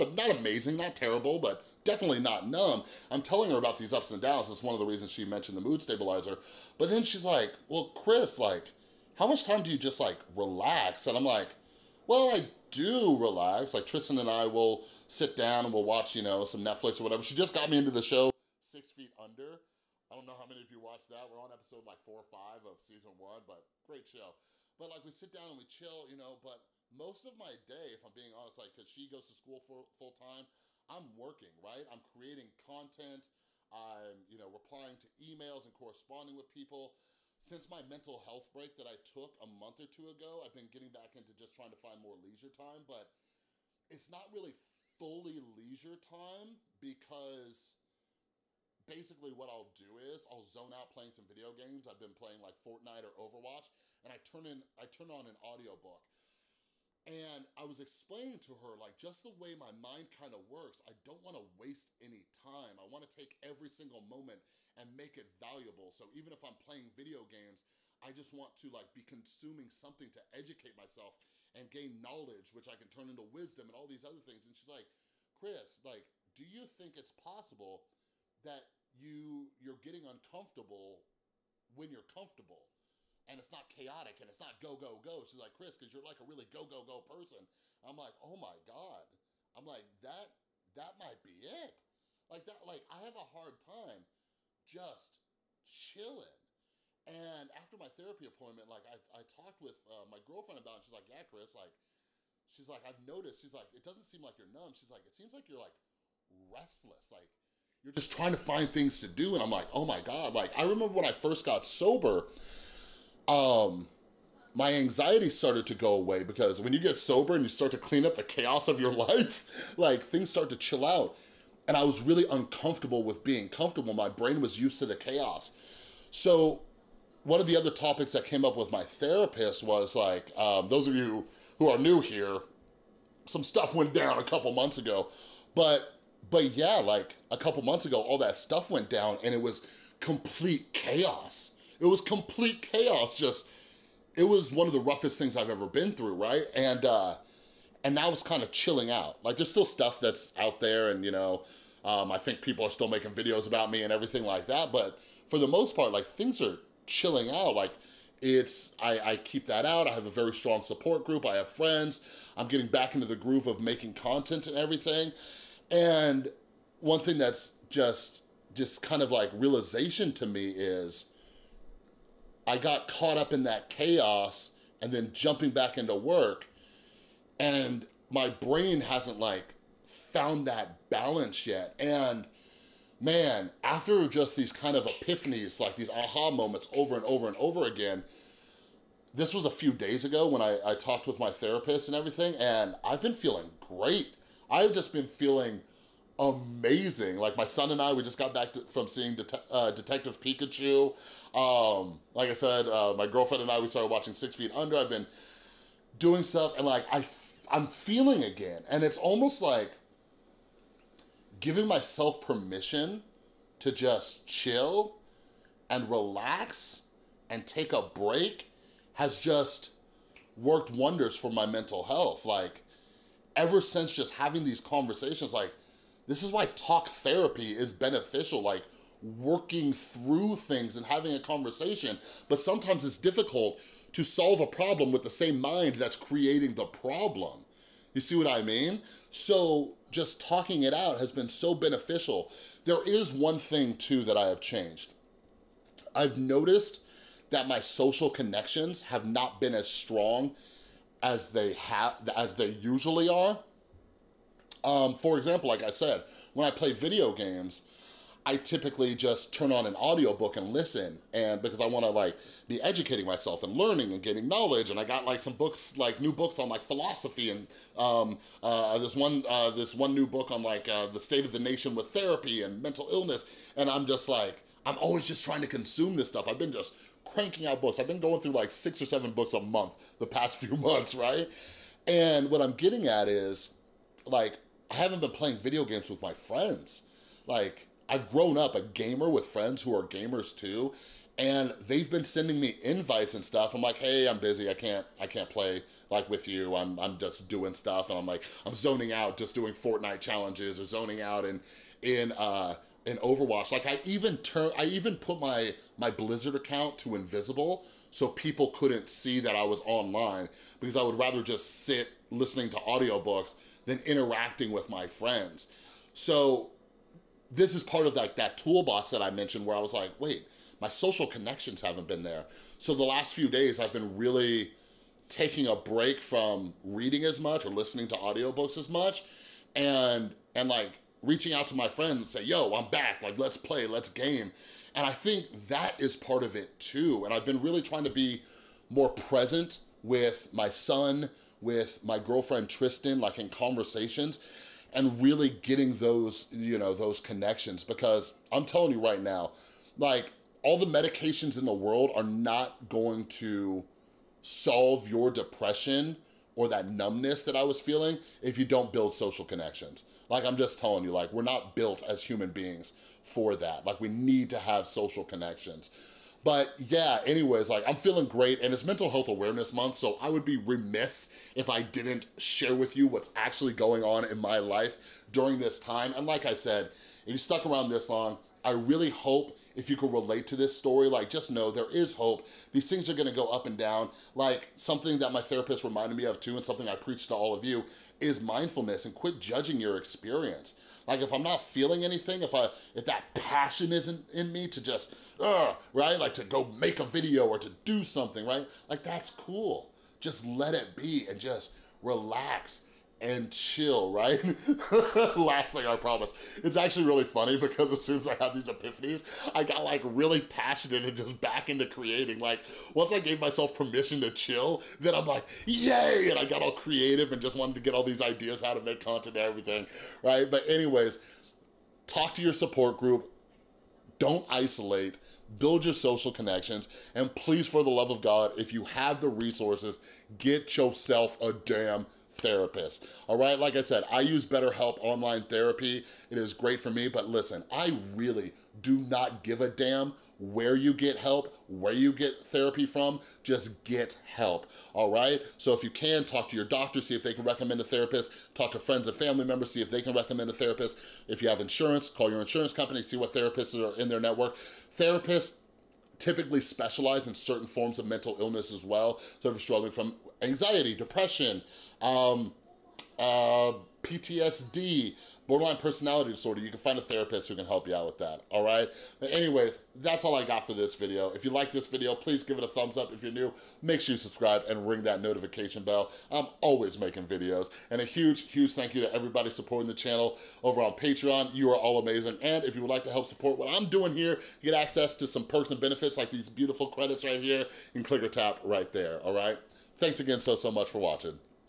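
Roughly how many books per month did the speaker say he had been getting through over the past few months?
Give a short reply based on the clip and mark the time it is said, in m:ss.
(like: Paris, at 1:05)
6 or 7, at 4:38.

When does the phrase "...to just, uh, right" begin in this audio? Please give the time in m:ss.
6:34.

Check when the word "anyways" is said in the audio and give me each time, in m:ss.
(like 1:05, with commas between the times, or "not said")
6:07, 7:00, 7:49.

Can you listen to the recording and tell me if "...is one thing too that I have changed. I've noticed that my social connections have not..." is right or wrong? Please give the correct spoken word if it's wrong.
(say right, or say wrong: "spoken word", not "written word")
right.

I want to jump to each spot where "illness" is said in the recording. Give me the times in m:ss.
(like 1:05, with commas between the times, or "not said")
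4:32, 7:38.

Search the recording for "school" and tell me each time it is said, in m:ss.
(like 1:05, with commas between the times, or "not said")
0:29.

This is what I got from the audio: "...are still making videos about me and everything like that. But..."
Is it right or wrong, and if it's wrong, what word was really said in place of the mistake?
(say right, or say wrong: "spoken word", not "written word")
right.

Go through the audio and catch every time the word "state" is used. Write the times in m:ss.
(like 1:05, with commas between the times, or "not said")
4:30.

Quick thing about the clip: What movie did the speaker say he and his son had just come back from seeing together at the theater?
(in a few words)
Detective Pikachu.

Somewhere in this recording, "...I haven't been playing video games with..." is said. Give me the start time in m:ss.
4:44.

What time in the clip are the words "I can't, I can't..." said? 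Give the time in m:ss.
4:54.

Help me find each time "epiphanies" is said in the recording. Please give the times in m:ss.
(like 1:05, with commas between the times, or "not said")
3:04, 6:48.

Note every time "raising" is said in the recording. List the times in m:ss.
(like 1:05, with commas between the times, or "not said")
not said.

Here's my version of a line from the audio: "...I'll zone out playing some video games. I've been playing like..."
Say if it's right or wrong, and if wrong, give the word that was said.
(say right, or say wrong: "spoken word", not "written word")
right.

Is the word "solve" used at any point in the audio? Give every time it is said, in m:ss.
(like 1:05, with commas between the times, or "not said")
3:54, 5:54.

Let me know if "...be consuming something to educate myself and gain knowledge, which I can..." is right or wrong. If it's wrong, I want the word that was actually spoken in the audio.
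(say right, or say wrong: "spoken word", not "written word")
right.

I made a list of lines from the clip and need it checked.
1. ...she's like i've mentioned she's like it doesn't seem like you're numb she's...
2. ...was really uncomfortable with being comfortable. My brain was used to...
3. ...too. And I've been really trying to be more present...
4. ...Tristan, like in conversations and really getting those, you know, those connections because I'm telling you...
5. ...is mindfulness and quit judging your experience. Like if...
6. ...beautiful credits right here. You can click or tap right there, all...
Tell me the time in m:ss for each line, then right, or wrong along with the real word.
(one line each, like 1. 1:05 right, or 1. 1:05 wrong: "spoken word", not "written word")
1. 1:42 wrong: "noticed", not "mentioned"
2. 2:01 right
3. 5:36 right
4. 5:42 right
5. 6:27 right
6. 8:06 right.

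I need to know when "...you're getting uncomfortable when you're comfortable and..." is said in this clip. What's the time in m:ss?
1:19.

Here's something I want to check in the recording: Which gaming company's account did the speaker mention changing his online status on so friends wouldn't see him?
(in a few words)
Blizzard.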